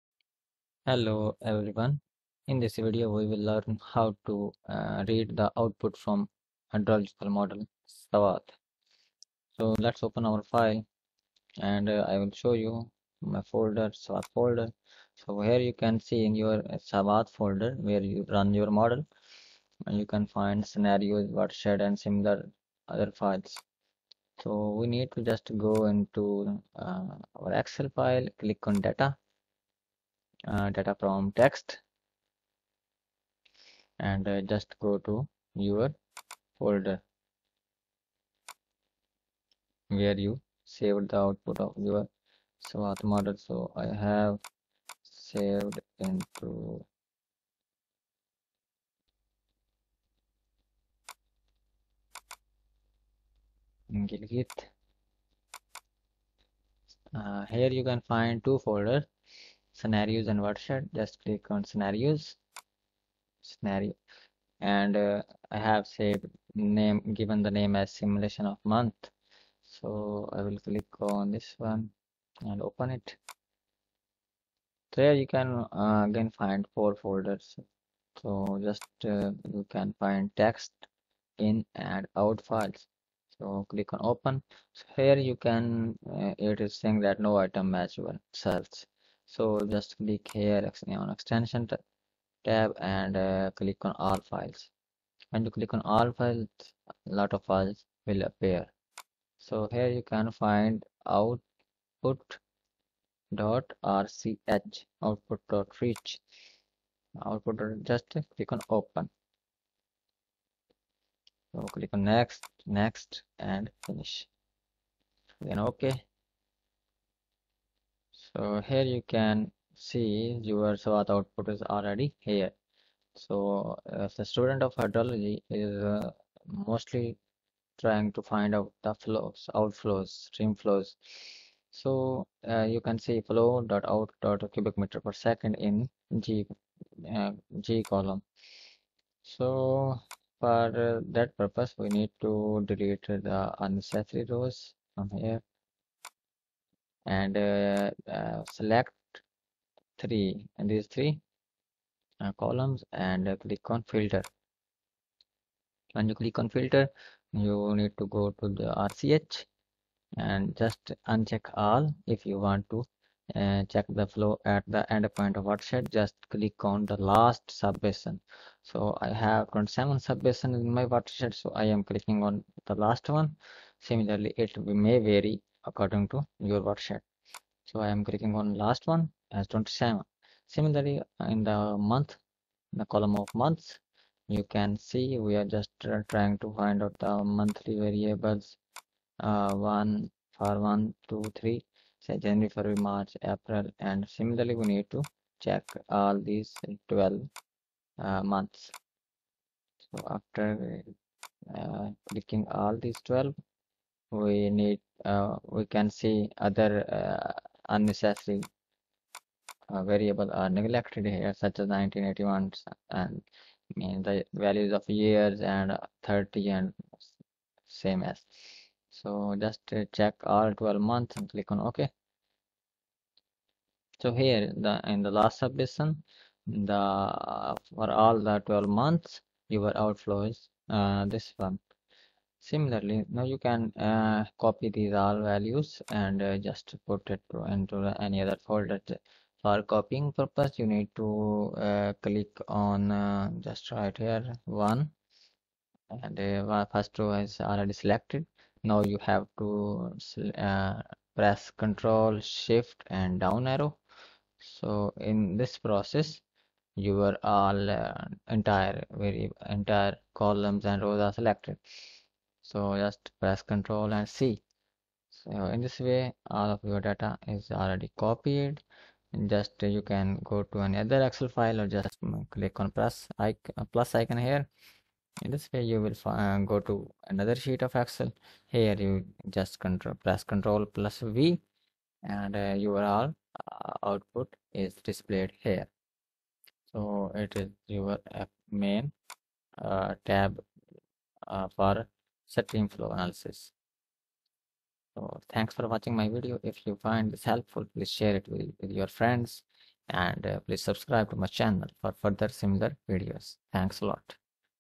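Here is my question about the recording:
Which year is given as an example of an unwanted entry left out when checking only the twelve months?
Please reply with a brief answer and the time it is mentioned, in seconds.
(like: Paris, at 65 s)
1981, at 211 s.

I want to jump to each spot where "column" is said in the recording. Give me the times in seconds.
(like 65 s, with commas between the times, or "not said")
137 s, 152 s, 182 s, 260 s.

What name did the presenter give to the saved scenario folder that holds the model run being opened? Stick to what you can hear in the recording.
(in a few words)
simulation of month.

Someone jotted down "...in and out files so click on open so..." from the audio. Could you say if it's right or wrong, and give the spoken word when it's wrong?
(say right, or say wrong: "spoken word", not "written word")
right.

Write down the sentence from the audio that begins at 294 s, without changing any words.
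So thanks for watching my video.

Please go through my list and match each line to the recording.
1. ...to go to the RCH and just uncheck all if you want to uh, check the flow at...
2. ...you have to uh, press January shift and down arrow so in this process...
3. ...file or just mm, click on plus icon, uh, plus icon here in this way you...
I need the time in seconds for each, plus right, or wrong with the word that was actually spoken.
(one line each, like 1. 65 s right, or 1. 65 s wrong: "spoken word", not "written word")
1. 157 s right
2. 248 s wrong: "Control", not "January"
3. 271 s right.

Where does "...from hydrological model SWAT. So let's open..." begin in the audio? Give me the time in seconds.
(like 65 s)
5 s.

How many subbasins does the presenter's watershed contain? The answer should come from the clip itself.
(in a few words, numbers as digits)
27.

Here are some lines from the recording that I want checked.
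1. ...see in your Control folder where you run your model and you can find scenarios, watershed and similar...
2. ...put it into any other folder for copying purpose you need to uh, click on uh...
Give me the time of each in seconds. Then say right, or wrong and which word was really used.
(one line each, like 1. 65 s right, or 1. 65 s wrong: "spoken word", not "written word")
1. 15 s wrong: "SWAT", not "Control"
2. 236 s right.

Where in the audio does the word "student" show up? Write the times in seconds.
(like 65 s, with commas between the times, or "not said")
124 s.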